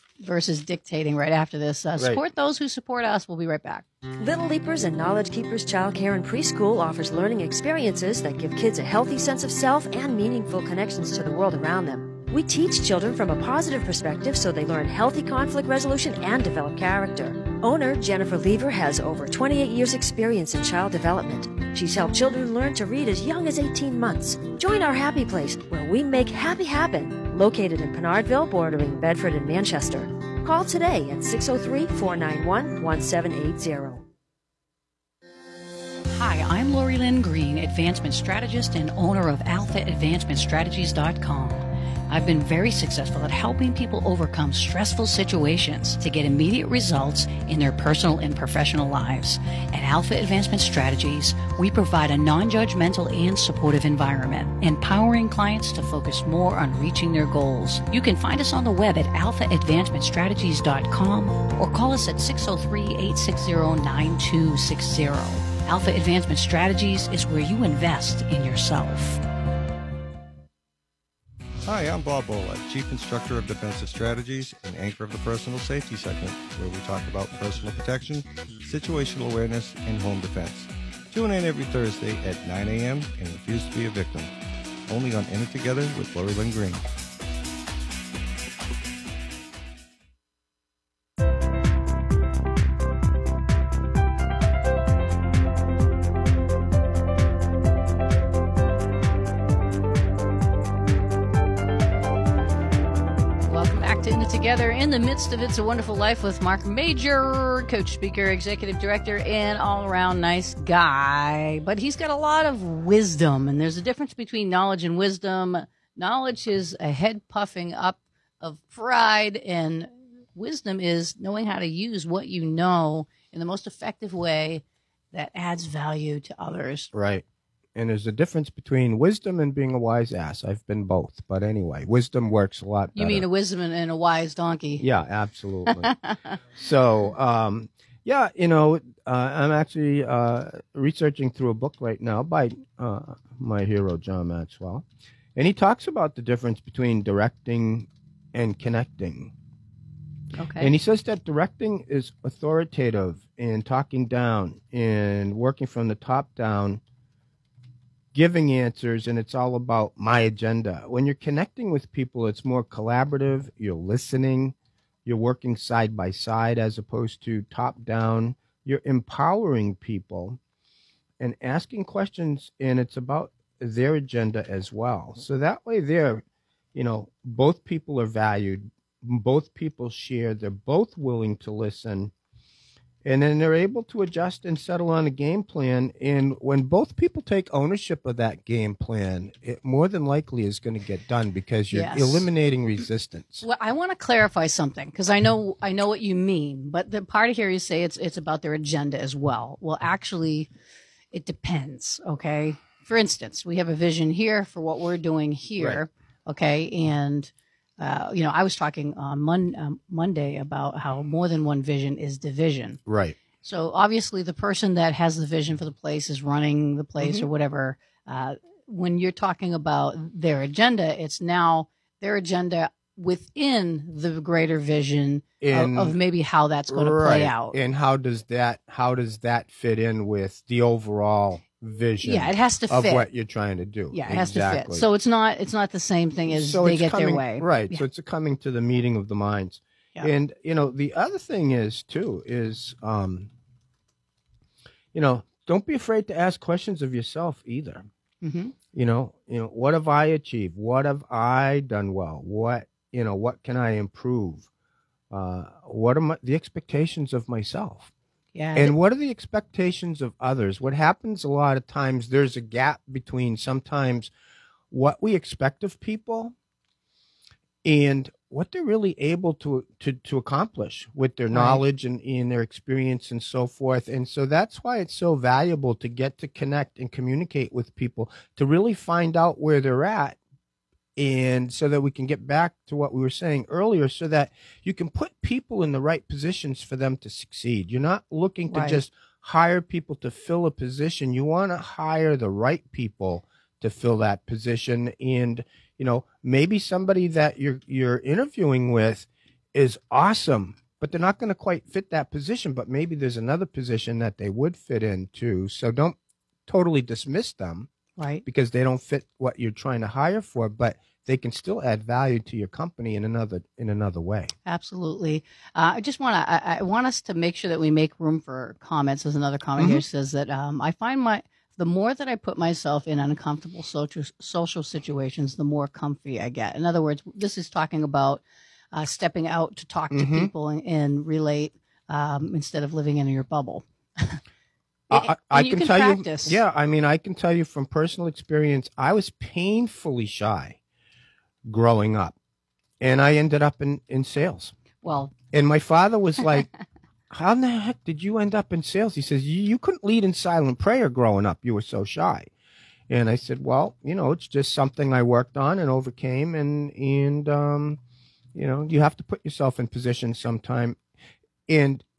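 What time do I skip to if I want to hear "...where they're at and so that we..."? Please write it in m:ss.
4:39.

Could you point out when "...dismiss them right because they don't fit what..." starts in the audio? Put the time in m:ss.
5:06.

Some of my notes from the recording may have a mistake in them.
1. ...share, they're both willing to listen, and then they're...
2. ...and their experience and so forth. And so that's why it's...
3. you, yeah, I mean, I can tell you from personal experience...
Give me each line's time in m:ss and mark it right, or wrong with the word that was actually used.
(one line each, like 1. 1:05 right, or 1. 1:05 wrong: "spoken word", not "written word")
1. 2:59 right
2. 4:32 right
3. 5:36 right.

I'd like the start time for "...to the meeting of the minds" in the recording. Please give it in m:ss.
3:58.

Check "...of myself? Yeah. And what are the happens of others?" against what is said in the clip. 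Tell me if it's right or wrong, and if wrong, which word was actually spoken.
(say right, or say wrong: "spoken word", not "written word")
wrong: "expectations", not "happens".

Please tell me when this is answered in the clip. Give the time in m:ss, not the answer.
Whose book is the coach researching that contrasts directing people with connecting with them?
2:23.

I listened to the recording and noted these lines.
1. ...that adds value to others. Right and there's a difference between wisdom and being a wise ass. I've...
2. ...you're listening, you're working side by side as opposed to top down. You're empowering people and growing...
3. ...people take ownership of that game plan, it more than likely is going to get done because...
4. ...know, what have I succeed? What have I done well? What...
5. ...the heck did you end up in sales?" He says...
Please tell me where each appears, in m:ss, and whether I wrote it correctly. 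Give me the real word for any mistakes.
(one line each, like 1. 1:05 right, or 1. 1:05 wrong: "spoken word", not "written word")
1. 2:05 right
2. 2:43 wrong: "asking", not "growing"
3. 3:06 right
4. 4:09 wrong: "achieved", not "succeed"
5. 5:47 right.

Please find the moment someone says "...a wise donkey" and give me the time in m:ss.
2:13.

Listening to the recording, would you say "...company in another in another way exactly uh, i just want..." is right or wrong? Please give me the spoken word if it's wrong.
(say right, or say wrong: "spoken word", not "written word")
wrong: "absolutely", not "exactly".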